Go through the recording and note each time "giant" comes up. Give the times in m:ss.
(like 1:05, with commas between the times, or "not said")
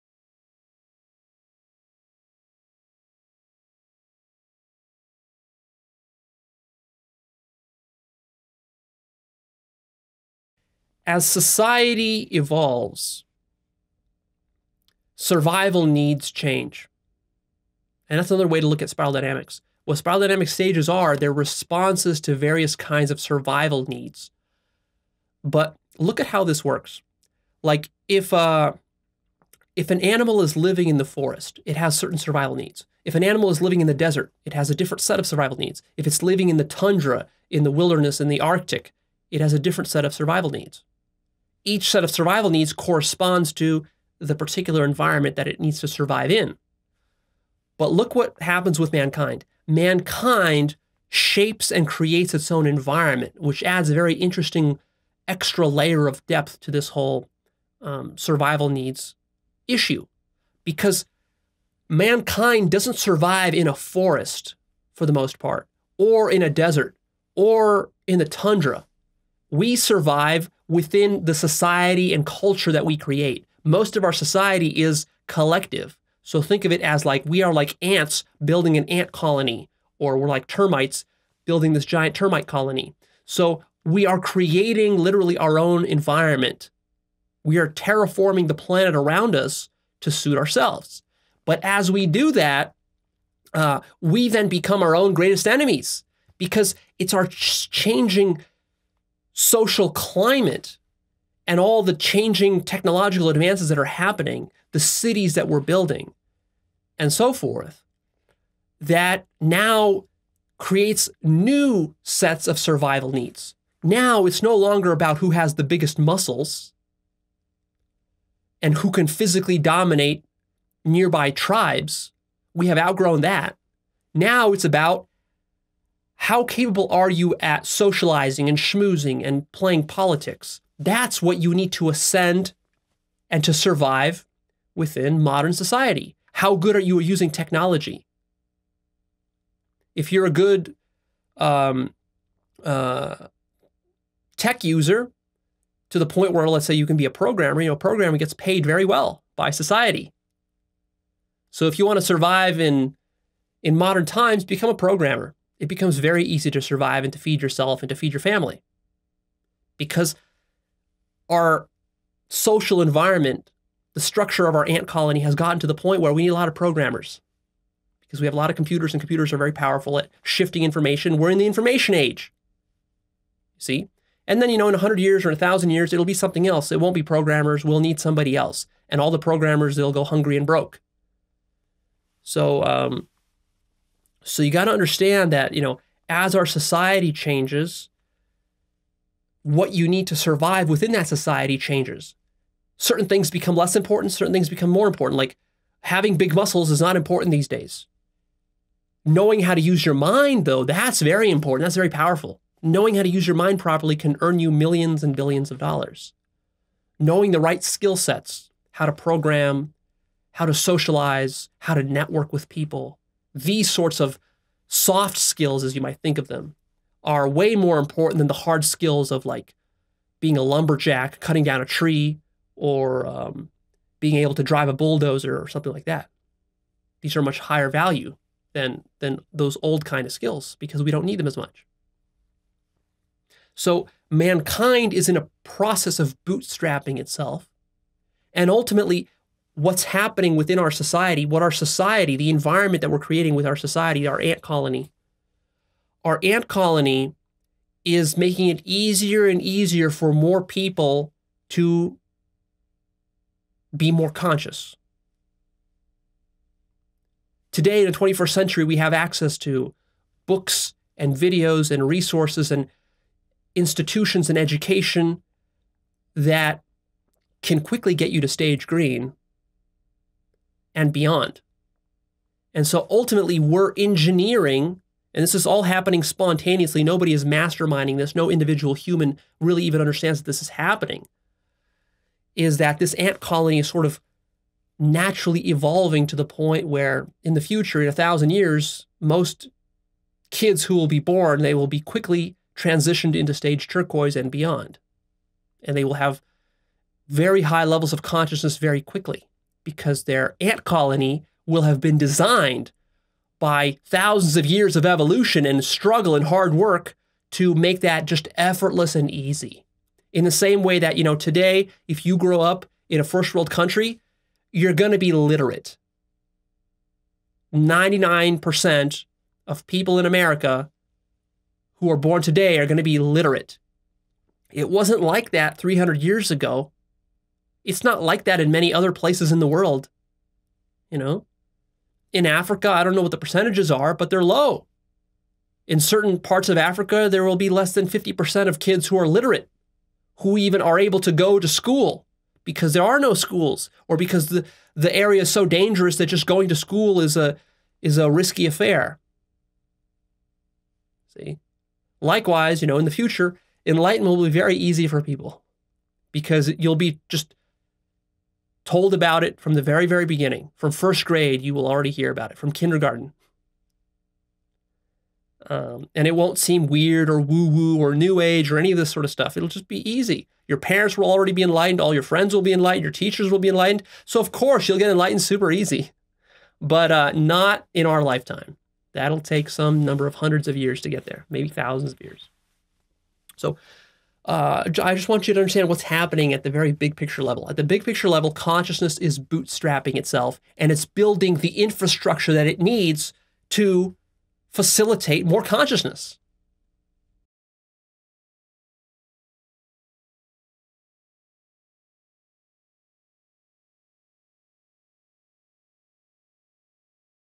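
1:21.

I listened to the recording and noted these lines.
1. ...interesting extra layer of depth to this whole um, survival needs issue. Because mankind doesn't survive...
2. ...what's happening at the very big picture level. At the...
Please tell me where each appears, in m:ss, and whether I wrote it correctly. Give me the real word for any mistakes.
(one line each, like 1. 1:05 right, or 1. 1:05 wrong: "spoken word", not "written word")
1. 0:54 right
2. 6:25 right.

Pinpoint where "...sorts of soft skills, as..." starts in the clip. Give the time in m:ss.
3:33.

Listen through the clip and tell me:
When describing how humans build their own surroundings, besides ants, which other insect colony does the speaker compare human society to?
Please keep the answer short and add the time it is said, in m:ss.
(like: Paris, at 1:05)
termites, at 1:20.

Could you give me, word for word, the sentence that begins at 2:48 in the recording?
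Because we have a lot of computers and computers are very powerful at shifting information.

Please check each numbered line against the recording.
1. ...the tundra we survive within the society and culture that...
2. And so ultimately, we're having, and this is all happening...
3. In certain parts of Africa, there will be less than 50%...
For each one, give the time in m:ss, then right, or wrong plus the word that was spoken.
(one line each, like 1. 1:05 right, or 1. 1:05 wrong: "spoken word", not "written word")
1. 1:08 right
2. 4:32 wrong: "engineering", not "having"
3. 5:35 right.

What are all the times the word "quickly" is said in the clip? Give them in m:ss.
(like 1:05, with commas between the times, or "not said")
4:27, 4:51, 4:58.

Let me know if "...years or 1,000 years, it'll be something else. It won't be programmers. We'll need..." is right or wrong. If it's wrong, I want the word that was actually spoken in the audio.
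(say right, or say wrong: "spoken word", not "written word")
right.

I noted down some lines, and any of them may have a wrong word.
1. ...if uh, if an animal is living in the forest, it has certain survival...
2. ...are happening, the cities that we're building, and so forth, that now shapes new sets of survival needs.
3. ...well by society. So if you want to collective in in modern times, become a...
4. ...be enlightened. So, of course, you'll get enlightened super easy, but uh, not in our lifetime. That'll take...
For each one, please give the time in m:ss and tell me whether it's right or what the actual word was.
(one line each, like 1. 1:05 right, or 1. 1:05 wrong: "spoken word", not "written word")
1. 0:28 right
2. 1:43 wrong: "creates", not "shapes"
3. 2:28 wrong: "survive", not "collective"
4. 6:13 right.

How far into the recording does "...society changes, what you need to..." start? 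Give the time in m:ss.
3:06.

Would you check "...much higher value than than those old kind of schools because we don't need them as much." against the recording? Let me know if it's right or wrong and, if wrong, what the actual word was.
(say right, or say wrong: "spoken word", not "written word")
wrong: "skills", not "schools".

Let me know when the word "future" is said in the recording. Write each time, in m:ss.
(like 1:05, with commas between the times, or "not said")
4:47, 5:52.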